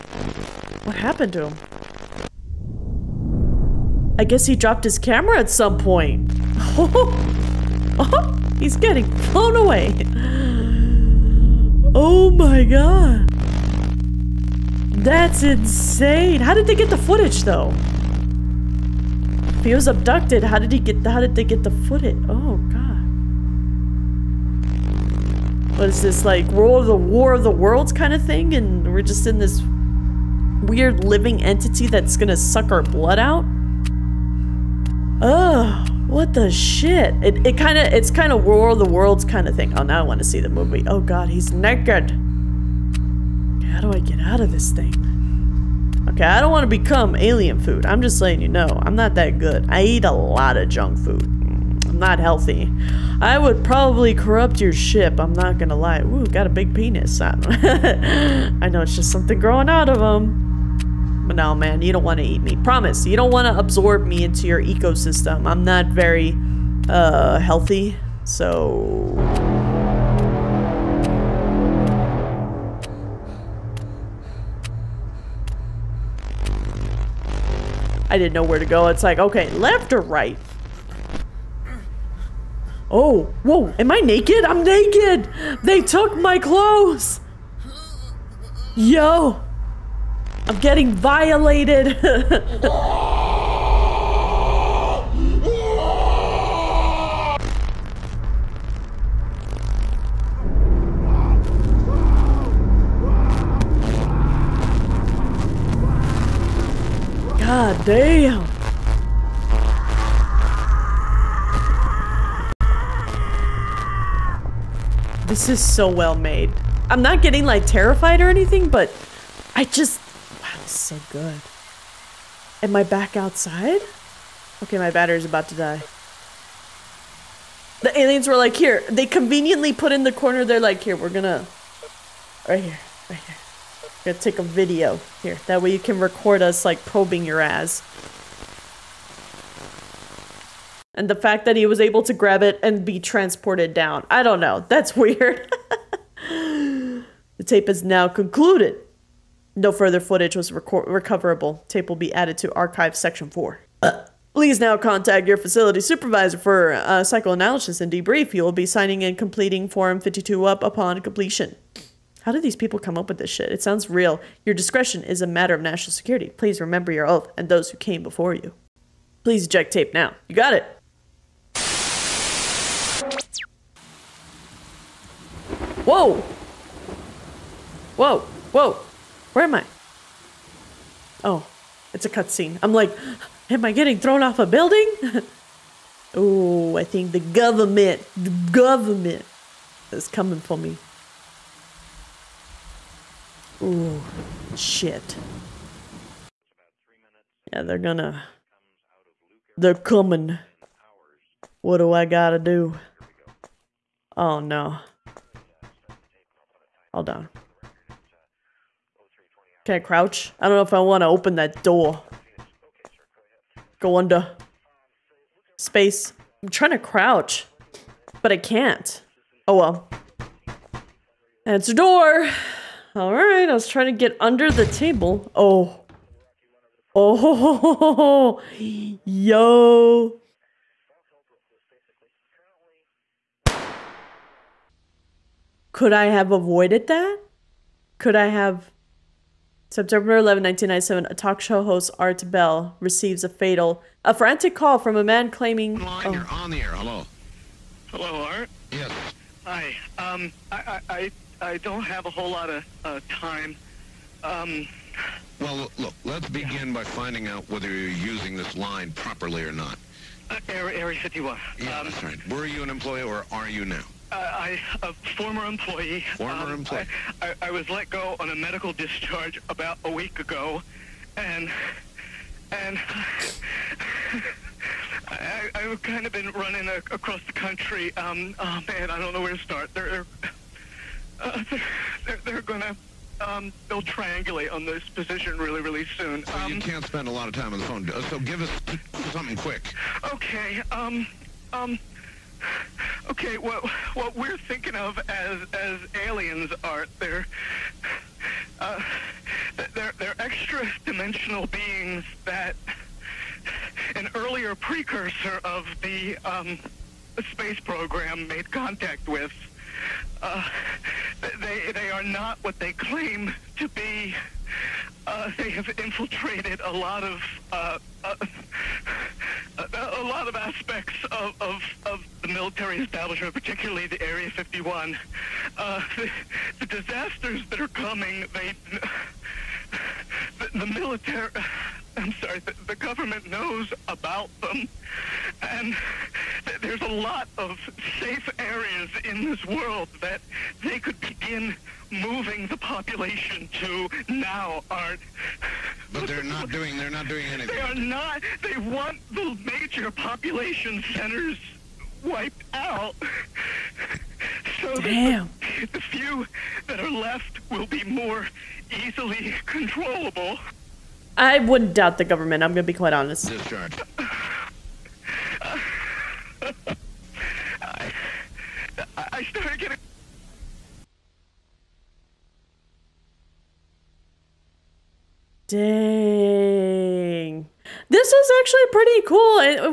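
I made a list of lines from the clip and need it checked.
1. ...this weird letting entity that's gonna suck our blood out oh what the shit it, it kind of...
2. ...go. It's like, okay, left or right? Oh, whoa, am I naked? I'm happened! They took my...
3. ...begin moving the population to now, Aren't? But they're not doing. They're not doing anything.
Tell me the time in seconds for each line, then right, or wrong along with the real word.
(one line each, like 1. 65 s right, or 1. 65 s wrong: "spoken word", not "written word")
1. 29 s wrong: "living", not "letting"
2. 78 s wrong: "naked", not "happened"
3. 341 s right.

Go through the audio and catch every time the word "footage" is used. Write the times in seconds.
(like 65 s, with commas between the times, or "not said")
16 s, 21 s, 149 s.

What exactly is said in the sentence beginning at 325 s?
Uh, the, the, disasters that are coming, they, the, the military, I'm sorry, the, the, government knows about them.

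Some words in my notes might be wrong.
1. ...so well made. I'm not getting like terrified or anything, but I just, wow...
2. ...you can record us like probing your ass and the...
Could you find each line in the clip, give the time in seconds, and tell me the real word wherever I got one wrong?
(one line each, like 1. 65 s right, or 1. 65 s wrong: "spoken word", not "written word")
1. 115 s right
2. 135 s right.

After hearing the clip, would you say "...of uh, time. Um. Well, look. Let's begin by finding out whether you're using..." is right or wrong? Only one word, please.
right.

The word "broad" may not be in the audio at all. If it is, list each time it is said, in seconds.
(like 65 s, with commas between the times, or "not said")
not said.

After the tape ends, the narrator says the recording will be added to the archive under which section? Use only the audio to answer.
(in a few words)
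Section 4.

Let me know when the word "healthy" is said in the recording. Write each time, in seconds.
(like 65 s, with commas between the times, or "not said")
52 s, 67 s.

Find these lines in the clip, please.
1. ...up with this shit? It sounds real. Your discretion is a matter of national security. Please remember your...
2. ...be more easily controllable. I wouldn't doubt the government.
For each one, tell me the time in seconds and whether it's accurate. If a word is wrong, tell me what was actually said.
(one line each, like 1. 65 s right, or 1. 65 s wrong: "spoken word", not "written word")
1. 162 s right
2. 357 s right.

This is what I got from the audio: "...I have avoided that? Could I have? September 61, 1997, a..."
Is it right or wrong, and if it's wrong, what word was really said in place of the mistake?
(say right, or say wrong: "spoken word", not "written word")
wrong: "11", not "61".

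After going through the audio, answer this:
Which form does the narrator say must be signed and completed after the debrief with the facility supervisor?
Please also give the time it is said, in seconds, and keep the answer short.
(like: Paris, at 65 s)
Form 52, at 159 s.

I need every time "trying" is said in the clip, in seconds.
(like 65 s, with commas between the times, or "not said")
216 s, 223 s.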